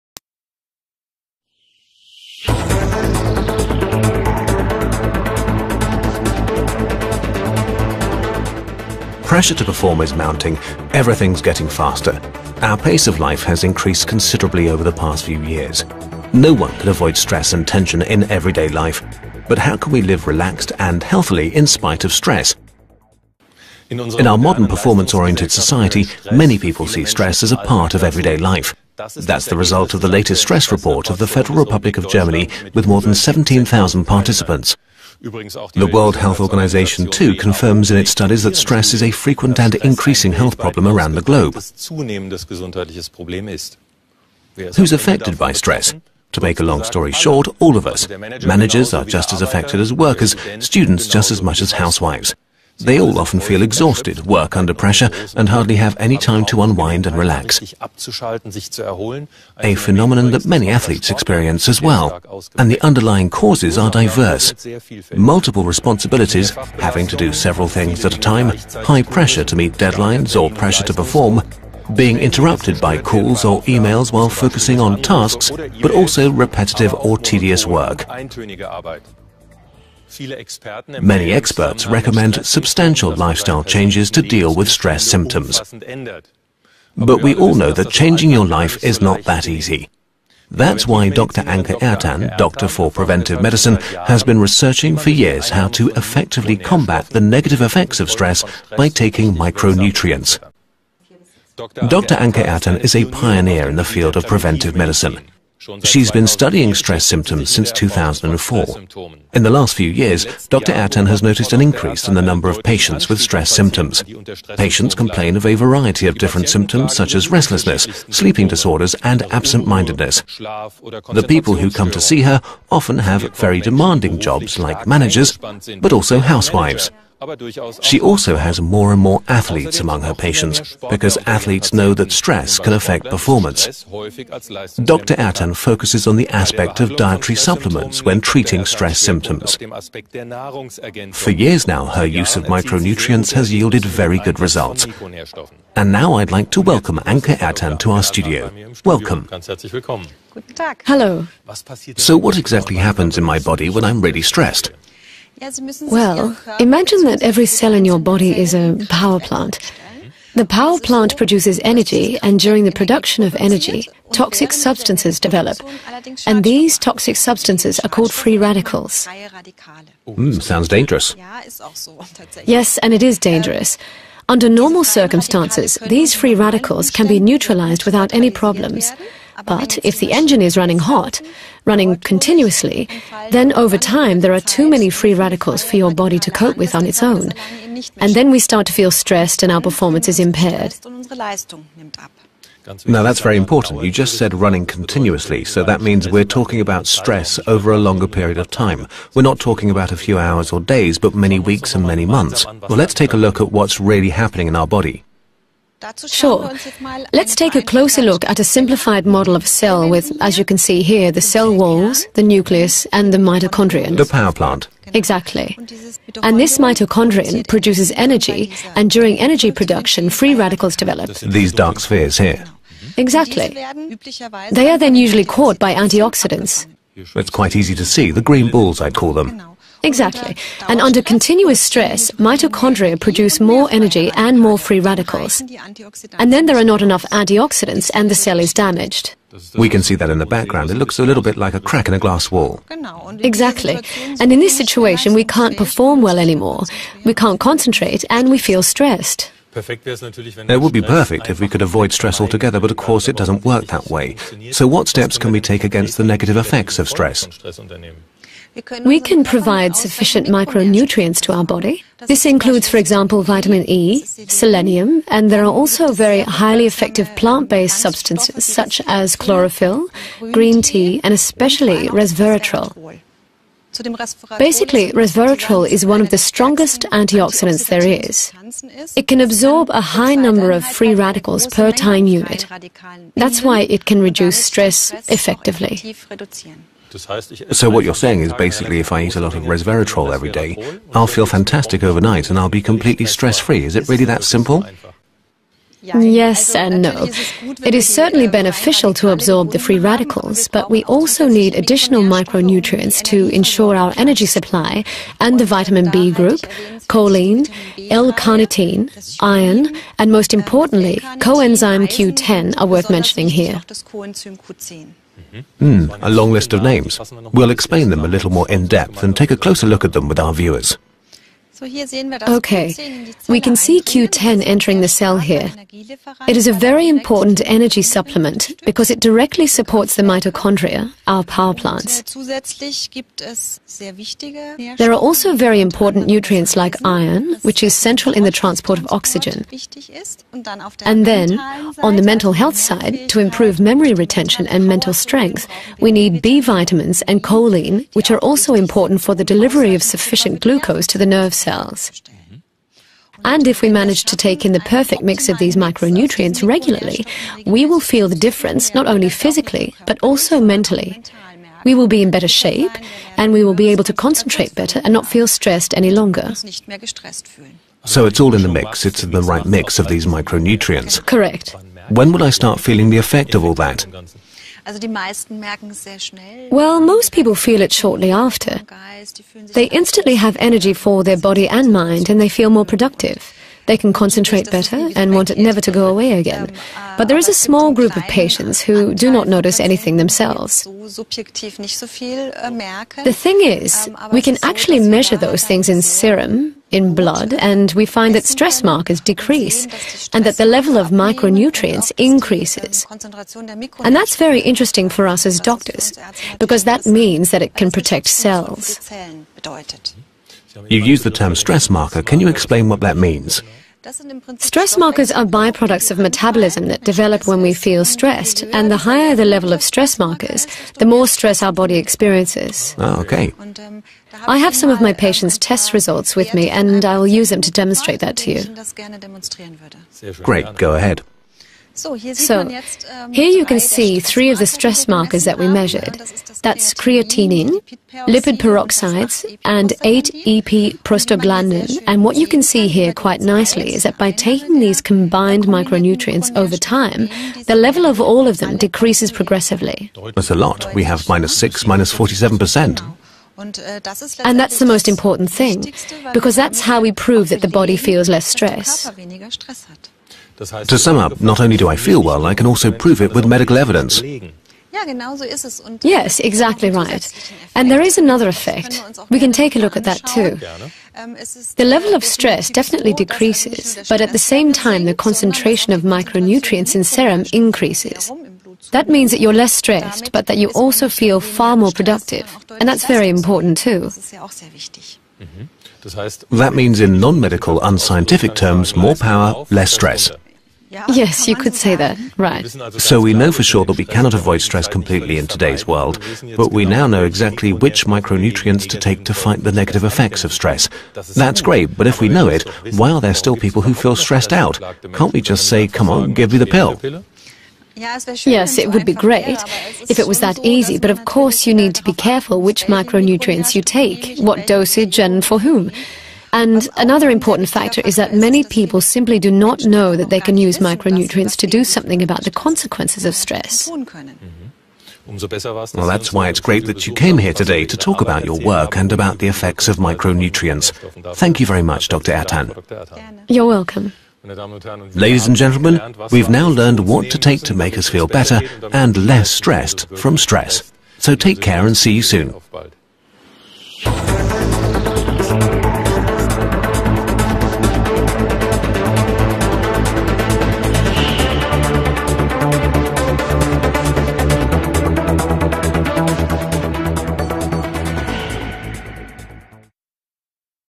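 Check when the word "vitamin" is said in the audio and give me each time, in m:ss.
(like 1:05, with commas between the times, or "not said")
4:23, 5:05, 5:46.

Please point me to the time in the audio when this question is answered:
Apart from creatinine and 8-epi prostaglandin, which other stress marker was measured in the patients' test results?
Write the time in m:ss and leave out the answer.
7:18.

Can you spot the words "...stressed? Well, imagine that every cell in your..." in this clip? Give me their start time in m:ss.
2:34.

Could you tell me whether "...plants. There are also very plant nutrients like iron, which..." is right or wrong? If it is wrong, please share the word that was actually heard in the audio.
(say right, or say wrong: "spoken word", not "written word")
wrong: "important", not "plant".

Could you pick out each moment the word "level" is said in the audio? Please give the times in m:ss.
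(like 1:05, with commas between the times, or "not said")
6:40, 6:59, 7:27, 7:51.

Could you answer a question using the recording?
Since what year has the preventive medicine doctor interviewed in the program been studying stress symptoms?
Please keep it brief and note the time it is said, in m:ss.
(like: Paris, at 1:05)
2004, at 1:47.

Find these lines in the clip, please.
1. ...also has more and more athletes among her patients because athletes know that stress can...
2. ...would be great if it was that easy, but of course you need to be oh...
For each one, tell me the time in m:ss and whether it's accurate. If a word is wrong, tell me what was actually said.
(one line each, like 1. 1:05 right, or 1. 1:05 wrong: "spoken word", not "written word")
1. 2:08 right
2. 8:28 right.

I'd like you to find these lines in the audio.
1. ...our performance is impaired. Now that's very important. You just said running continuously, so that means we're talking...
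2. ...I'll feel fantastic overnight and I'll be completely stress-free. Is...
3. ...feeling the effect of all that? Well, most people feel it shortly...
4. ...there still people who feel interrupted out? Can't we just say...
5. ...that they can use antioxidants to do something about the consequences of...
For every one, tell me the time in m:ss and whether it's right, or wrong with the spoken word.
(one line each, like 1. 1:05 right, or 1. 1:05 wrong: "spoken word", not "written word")
1. 3:09 right
2. 4:50 right
3. 6:12 right
4. 8:23 wrong: "stressed", not "interrupted"
5. 8:39 wrong: "micronutrients", not "antioxidants".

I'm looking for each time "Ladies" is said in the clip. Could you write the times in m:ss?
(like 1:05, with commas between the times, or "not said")
8:54.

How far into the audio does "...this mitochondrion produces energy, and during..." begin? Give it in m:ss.
3:36.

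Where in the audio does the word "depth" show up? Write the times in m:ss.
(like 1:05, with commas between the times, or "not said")
5:18.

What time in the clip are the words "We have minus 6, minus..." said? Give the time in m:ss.
7:30.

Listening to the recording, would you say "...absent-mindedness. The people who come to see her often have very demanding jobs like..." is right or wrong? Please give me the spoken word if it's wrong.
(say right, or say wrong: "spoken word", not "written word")
right.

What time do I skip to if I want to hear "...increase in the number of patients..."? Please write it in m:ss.
1:51.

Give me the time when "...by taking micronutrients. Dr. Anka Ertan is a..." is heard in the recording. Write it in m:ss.
1:38.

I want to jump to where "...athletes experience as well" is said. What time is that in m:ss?
1:00.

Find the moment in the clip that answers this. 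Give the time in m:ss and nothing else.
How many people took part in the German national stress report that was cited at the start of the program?
0:32.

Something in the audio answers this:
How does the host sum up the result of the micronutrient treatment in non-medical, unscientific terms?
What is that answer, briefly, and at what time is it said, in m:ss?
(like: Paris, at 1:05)
more power, less stress, at 8:08.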